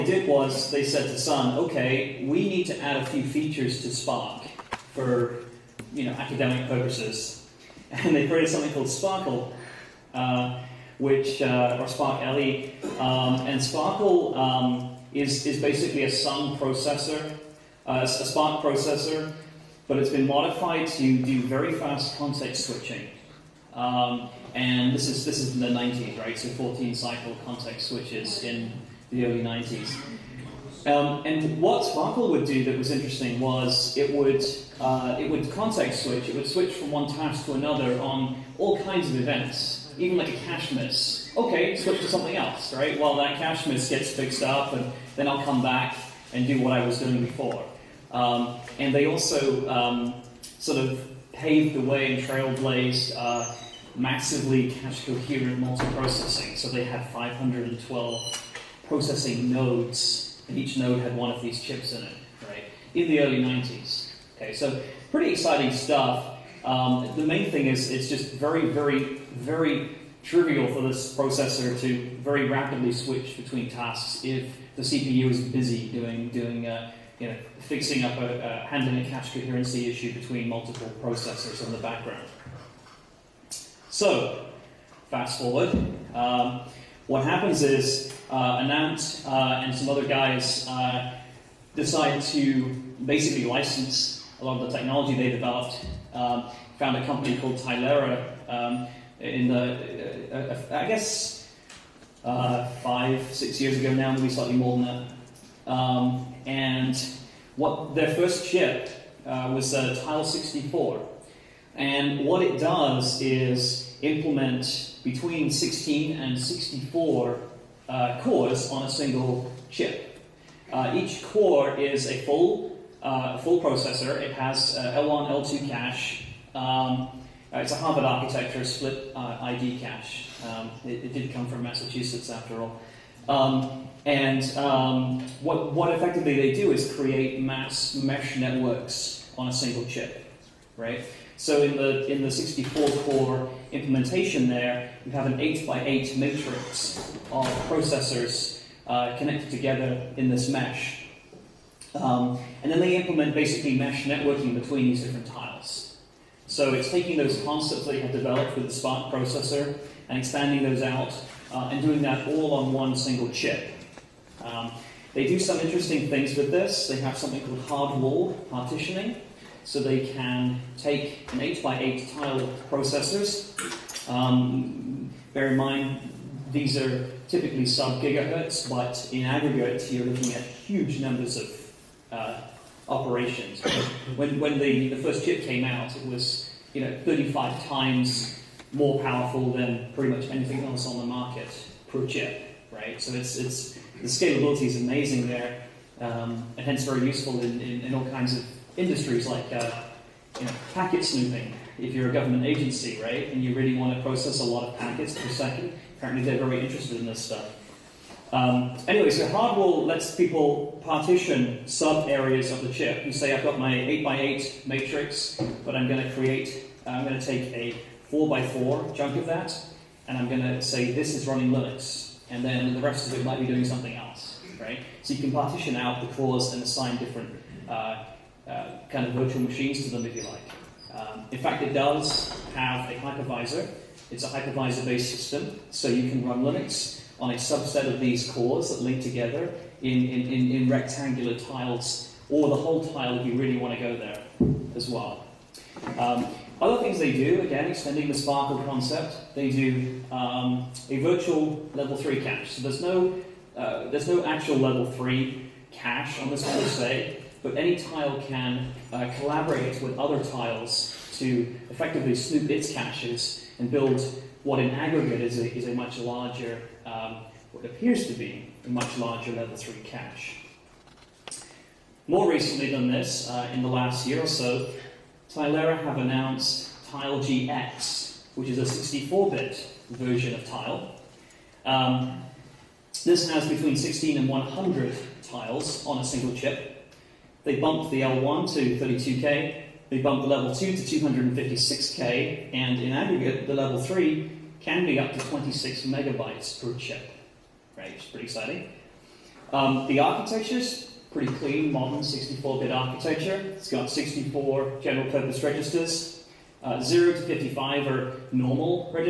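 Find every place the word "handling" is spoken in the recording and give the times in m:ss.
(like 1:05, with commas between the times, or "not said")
1:18.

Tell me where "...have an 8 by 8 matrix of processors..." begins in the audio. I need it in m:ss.
2:25.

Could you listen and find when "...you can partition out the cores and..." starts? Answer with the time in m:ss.
3:45.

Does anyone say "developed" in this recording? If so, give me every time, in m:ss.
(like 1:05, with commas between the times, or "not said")
1:35, 2:38.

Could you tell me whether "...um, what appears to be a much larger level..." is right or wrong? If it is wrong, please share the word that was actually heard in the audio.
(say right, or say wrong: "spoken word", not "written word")
right.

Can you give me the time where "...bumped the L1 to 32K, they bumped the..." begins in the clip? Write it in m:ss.
4:47.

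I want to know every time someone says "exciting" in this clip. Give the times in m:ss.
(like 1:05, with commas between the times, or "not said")
1:05, 4:58.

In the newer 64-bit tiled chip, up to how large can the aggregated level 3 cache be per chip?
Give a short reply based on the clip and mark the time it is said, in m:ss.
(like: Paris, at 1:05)
26 megabytes, at 4:55.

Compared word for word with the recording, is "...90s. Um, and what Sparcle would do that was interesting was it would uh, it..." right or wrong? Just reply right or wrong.
right.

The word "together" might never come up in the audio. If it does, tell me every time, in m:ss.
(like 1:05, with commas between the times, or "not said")
2:29, 3:59.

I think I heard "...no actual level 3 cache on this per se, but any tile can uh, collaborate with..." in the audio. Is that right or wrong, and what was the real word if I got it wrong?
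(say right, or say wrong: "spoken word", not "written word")
right.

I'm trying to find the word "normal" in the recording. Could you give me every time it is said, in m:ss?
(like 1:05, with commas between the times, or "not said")
5:08.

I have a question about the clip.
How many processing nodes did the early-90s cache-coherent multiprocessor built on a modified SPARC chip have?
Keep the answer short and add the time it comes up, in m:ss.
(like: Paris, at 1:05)
512, at 0:57.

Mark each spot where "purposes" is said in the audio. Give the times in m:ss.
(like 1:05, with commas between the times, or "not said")
0:06, 5:05.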